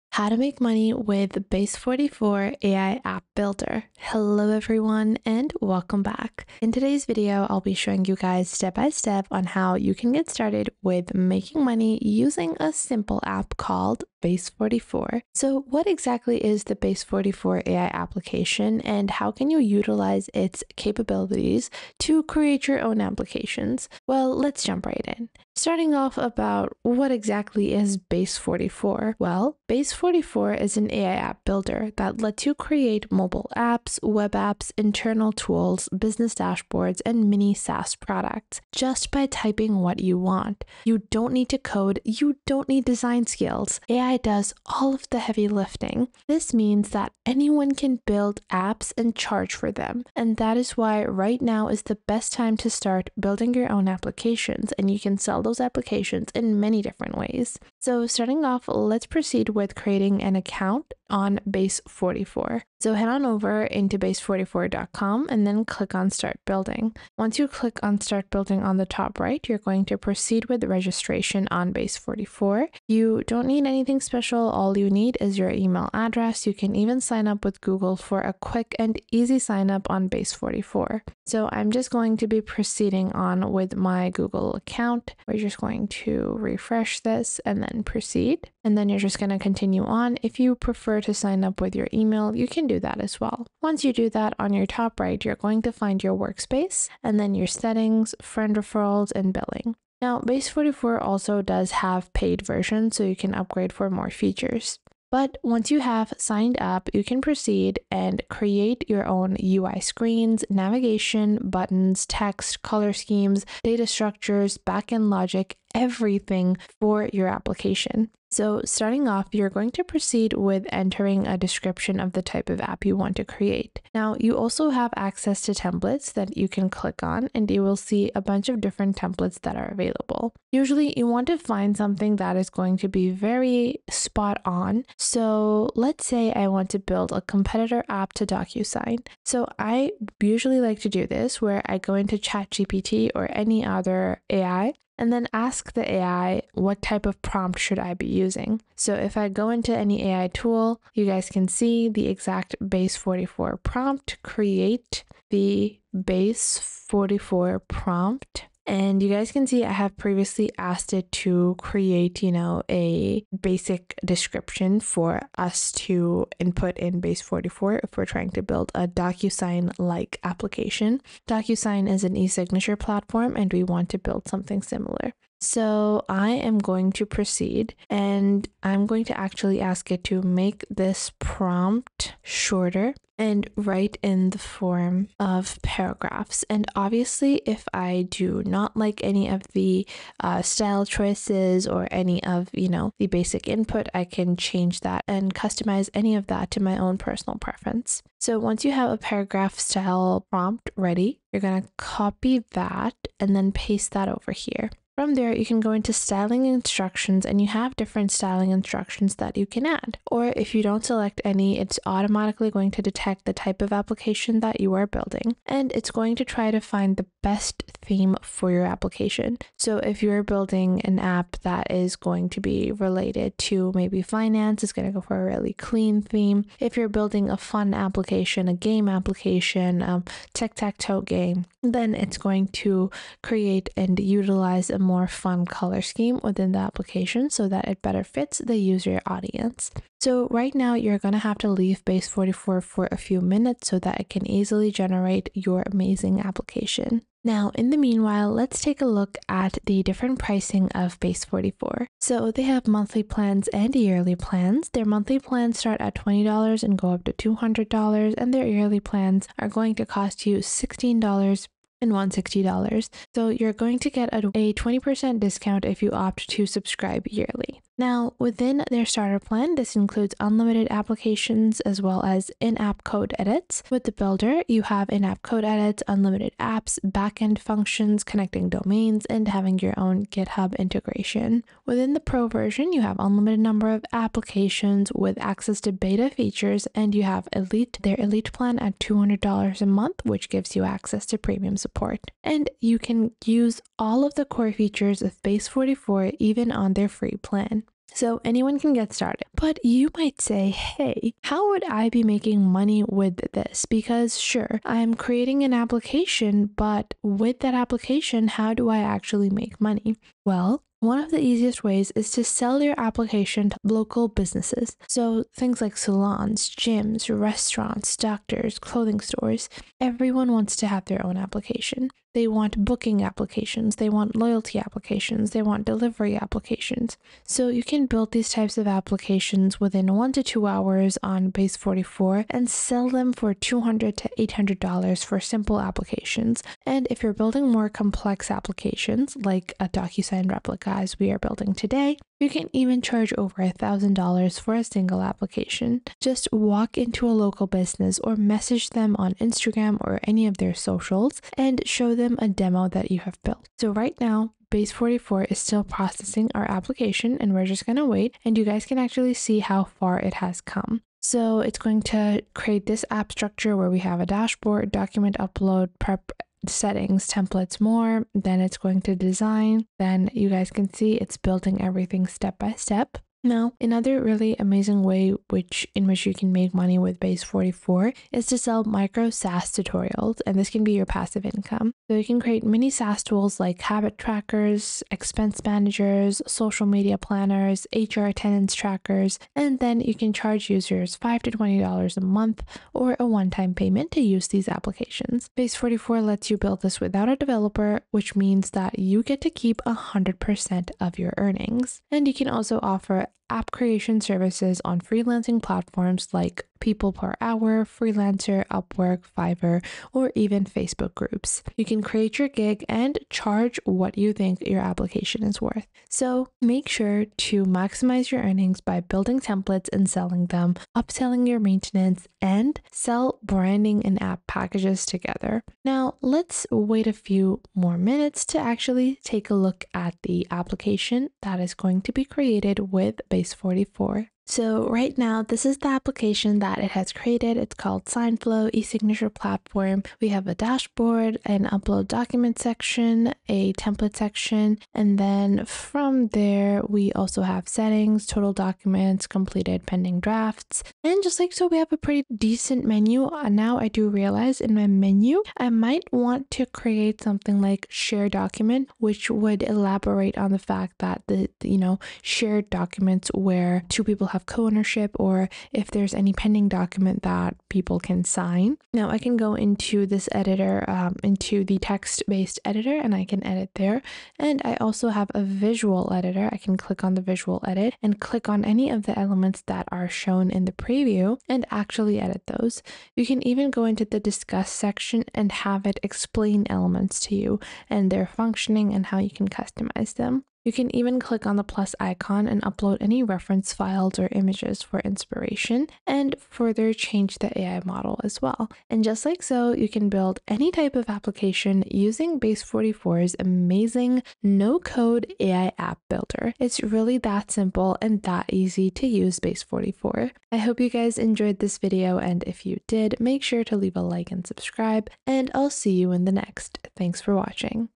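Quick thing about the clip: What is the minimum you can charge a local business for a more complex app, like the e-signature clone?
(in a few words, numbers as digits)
over $1,000.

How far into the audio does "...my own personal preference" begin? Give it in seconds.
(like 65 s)
196 s.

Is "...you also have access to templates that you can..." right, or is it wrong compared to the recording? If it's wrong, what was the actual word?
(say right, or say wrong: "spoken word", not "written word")
right.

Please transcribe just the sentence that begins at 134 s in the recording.
So let's say I want to build a competitor app to DocuSign.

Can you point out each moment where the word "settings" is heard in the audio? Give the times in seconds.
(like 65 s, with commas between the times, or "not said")
97 s, 366 s, 447 s.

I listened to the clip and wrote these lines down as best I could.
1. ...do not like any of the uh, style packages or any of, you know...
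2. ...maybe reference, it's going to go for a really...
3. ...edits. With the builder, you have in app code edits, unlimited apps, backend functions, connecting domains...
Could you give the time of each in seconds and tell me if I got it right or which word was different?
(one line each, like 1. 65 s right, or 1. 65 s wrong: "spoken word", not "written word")
1. 188 s wrong: "choices", not "packages"
2. 223 s wrong: "finance", not "reference"
3. 273 s right.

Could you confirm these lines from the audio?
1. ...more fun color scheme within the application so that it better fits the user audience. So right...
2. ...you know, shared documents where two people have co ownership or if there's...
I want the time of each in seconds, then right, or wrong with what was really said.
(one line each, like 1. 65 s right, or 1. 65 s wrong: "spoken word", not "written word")
1. 234 s right
2. 461 s right.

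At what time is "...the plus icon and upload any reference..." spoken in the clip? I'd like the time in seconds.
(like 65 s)
491 s.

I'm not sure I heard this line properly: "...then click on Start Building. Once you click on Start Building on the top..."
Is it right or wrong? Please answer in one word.
right.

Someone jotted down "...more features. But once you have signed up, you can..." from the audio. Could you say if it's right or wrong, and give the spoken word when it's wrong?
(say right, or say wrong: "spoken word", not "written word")
right.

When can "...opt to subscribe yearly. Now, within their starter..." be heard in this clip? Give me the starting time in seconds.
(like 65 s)
265 s.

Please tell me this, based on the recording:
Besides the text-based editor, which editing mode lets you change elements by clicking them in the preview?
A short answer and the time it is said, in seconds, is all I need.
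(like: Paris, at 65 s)
visual editor, at 475 s.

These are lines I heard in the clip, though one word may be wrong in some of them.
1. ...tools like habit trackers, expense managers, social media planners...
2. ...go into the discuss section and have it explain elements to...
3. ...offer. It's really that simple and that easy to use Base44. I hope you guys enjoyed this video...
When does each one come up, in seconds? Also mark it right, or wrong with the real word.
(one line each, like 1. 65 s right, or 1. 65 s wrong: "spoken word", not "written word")
1. 383 s right
2. 483 s right
3. 505 s wrong: "builder", not "offer".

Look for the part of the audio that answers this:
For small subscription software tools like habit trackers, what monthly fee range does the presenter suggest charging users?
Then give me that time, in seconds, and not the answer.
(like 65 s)
390 s.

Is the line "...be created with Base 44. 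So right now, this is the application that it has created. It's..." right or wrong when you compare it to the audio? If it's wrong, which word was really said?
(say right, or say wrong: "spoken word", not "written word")
right.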